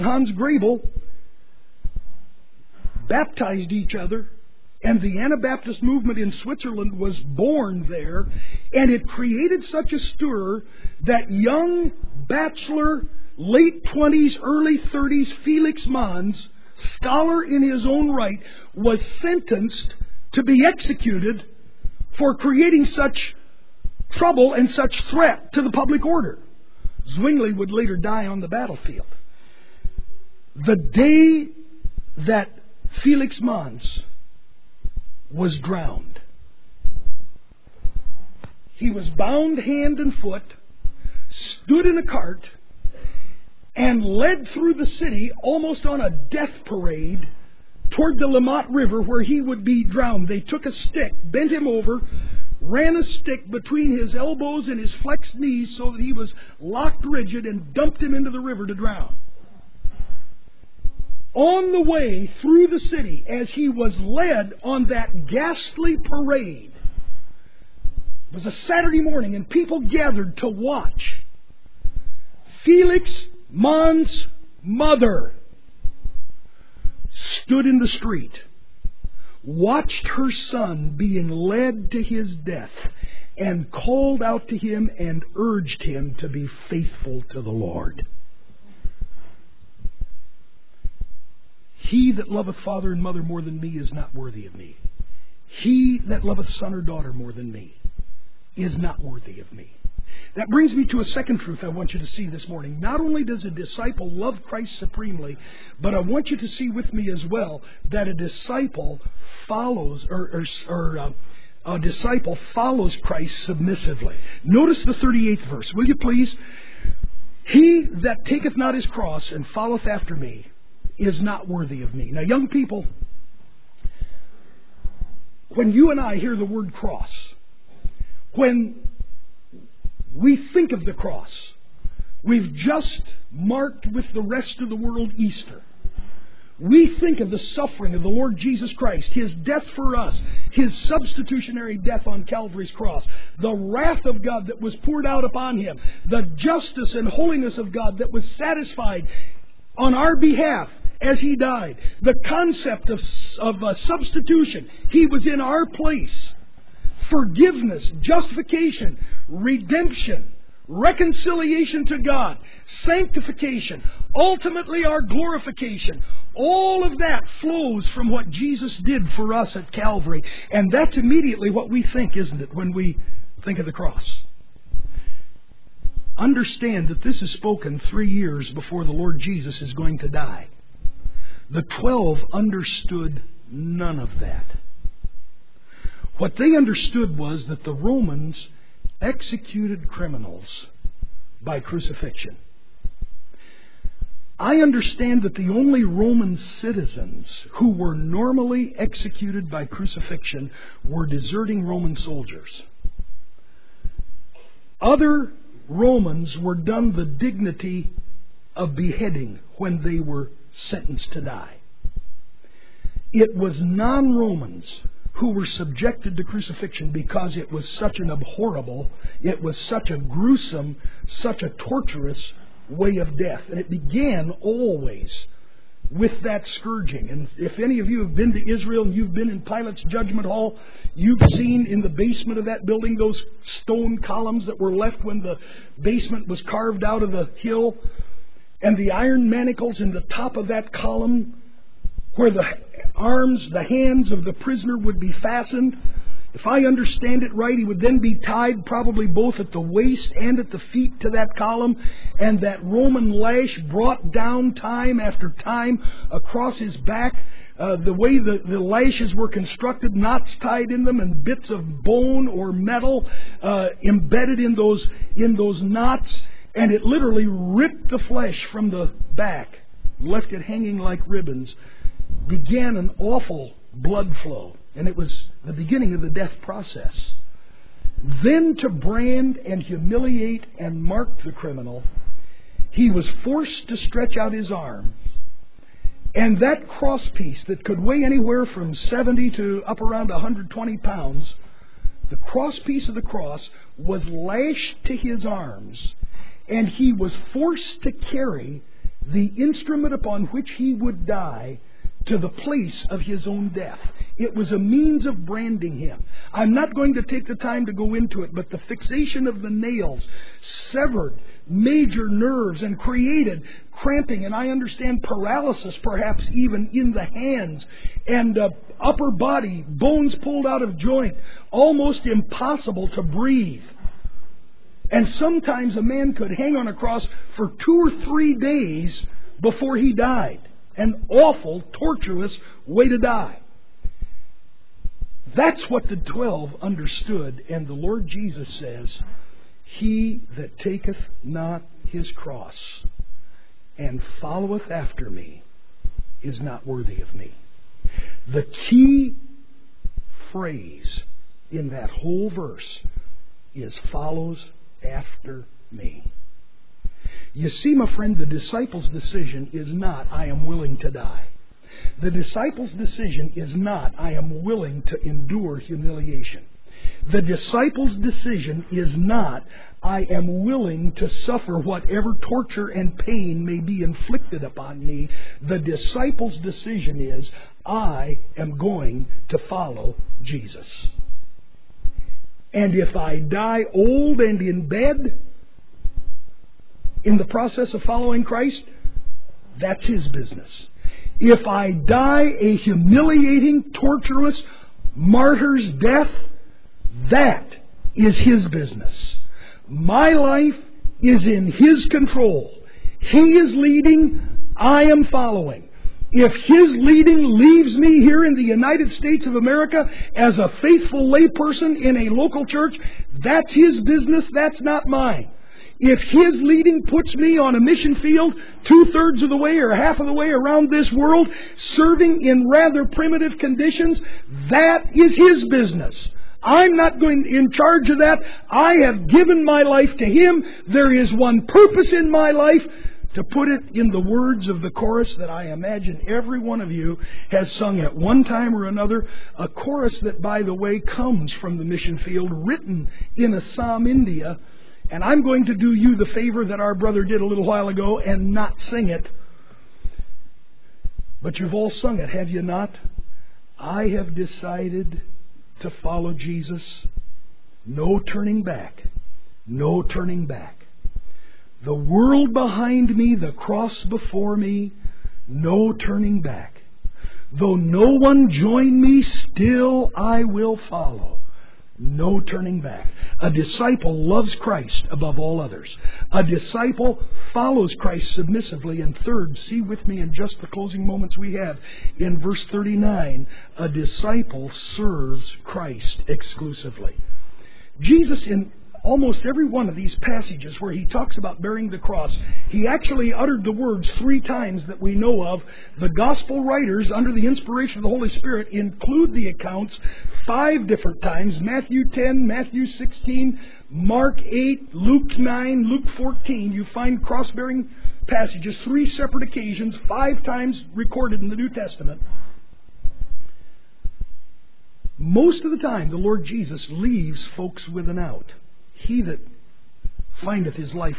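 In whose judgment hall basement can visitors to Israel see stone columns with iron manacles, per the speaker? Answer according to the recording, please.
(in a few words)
Pilate.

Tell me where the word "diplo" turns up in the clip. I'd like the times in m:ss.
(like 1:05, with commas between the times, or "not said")
not said.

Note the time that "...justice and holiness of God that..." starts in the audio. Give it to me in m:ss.
2:26.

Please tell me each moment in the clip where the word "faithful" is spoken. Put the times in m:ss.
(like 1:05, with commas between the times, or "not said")
1:26, 6:50.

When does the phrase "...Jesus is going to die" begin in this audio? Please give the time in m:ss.
2:59.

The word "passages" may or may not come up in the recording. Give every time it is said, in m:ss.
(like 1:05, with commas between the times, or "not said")
8:09, 8:28.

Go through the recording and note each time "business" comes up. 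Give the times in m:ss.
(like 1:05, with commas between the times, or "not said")
6:30, 6:38, 6:53, 7:05.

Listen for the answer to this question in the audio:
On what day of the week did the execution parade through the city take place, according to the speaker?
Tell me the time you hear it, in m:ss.
1:08.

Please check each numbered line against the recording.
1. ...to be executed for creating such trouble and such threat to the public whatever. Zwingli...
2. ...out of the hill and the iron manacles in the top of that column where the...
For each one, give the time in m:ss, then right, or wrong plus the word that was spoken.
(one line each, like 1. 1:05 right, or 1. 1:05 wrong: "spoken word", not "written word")
1. 0:20 wrong: "order", not "whatever"
2. 3:56 right.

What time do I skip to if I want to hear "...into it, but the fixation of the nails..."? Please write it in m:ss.
5:07.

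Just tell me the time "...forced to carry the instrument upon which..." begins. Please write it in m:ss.
4:57.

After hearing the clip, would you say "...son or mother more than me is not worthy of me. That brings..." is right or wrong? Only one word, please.
wrong.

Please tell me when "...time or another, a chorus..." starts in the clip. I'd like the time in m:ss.
7:18.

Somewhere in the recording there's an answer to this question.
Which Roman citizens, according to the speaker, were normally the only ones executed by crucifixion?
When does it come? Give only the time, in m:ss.
3:21.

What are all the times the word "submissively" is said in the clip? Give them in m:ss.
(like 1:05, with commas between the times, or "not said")
1:53, 7:58.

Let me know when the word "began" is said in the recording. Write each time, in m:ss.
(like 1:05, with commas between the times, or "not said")
3:43, 4:32.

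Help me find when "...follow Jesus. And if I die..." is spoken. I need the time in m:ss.
6:19.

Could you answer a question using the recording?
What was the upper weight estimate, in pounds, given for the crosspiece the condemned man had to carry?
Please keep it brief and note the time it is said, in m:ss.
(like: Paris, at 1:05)
120, at 4:50.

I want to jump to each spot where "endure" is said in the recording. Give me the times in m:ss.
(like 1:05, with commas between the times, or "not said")
6:05.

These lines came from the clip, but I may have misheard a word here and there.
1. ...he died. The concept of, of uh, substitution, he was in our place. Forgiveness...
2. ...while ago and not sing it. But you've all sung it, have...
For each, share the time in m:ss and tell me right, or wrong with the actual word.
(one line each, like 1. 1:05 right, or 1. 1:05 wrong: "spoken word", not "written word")
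1. 2:31 right
2. 7:27 right.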